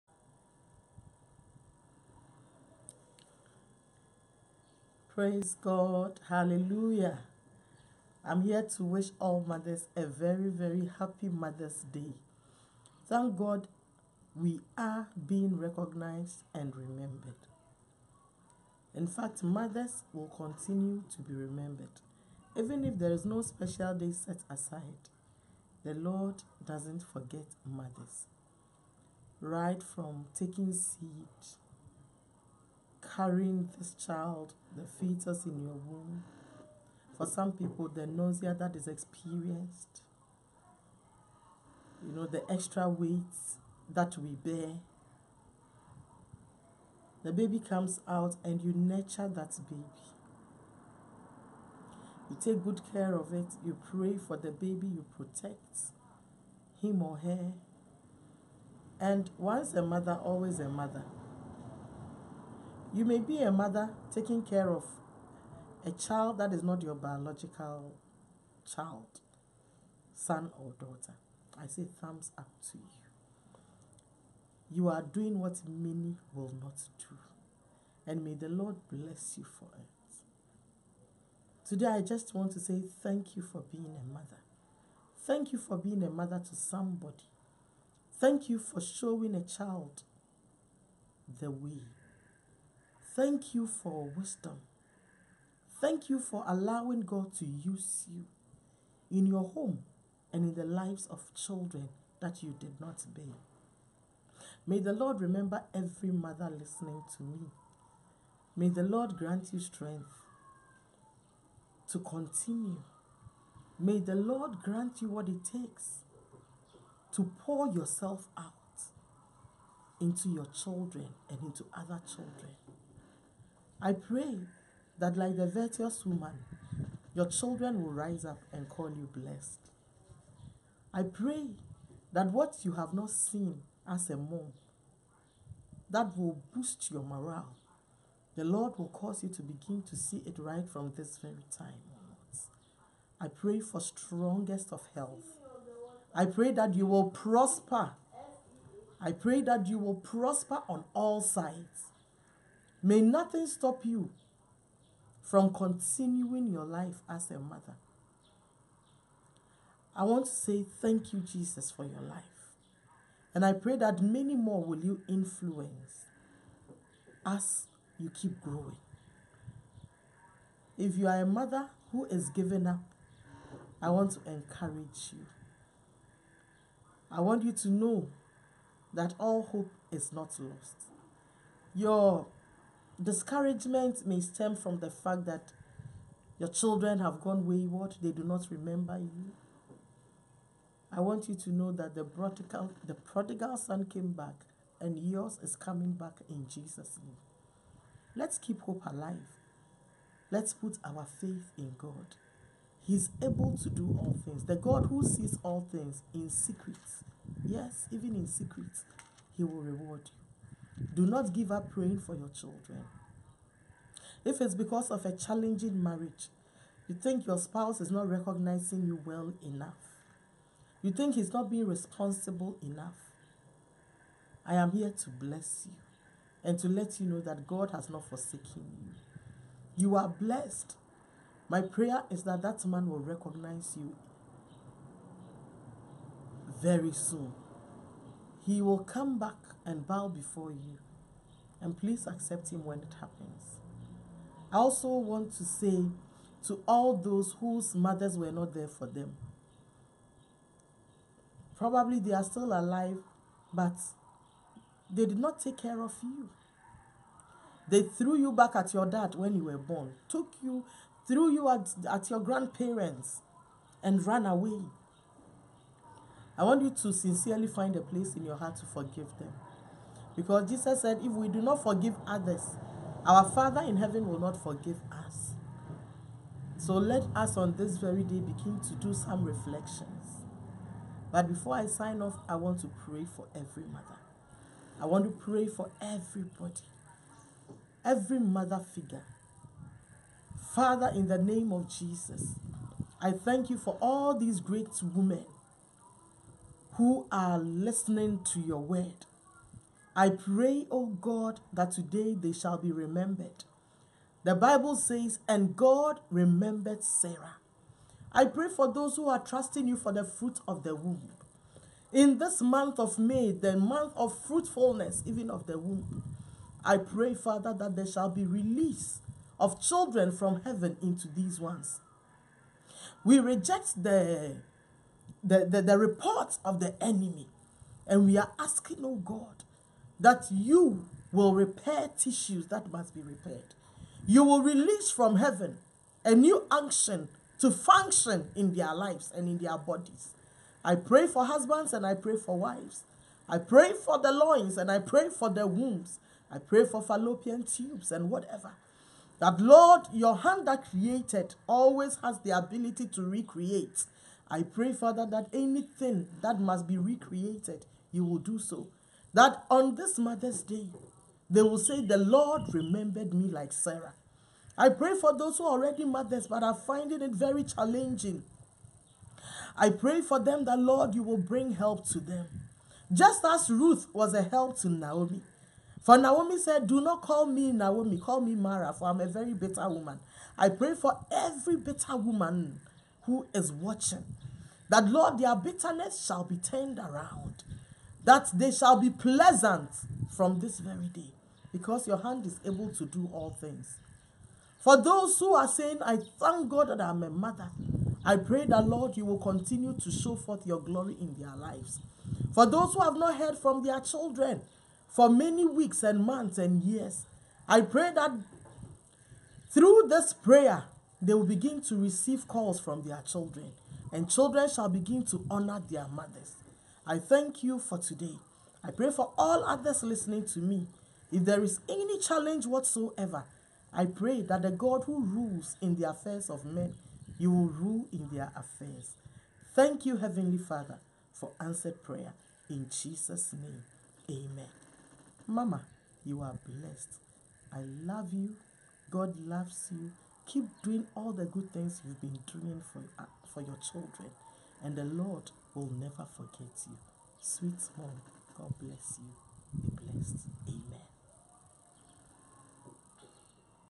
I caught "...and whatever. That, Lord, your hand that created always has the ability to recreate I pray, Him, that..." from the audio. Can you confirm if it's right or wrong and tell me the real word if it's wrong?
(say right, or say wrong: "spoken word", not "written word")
wrong: "Father", not "Him".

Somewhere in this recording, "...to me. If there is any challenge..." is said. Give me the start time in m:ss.
7:00.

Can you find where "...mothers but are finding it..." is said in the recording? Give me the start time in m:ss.
6:05.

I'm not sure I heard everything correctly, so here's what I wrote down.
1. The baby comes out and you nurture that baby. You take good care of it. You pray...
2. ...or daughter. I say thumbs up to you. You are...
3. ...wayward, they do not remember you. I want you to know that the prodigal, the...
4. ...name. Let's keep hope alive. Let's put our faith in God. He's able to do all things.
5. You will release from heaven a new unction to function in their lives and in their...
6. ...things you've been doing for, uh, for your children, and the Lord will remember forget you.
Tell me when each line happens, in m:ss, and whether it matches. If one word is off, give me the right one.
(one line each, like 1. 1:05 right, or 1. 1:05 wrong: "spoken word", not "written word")
1. 0:47 right
2. 1:10 right
3. 3:07 right
4. 3:17 right
5. 5:34 right
6. 7:21 wrong: "never", not "remember".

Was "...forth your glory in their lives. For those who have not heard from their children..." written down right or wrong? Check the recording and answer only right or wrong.
right.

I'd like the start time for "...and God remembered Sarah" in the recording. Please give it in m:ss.
5:05.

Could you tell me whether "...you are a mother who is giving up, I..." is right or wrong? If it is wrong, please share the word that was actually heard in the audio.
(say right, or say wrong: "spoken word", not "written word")
right.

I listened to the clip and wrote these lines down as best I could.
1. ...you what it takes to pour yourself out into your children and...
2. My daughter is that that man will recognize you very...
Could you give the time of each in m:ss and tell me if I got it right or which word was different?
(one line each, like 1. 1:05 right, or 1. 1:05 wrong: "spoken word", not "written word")
1. 1:55 right
2. 3:51 wrong: "prayer", not "daughter".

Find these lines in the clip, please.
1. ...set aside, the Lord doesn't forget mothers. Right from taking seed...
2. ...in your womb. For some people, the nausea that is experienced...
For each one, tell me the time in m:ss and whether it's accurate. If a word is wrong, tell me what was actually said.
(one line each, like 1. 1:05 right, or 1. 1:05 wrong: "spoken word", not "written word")
1. 0:24 right
2. 0:35 right.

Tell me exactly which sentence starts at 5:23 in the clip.
We reject the the, the, the reports of the enemy.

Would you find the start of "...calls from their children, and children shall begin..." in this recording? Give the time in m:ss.
6:52.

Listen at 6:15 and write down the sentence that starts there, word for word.
For Naomi said, Do not call me Naomi, call me Mara, for I'm a very bitter woman.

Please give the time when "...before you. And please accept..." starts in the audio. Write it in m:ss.
4:00.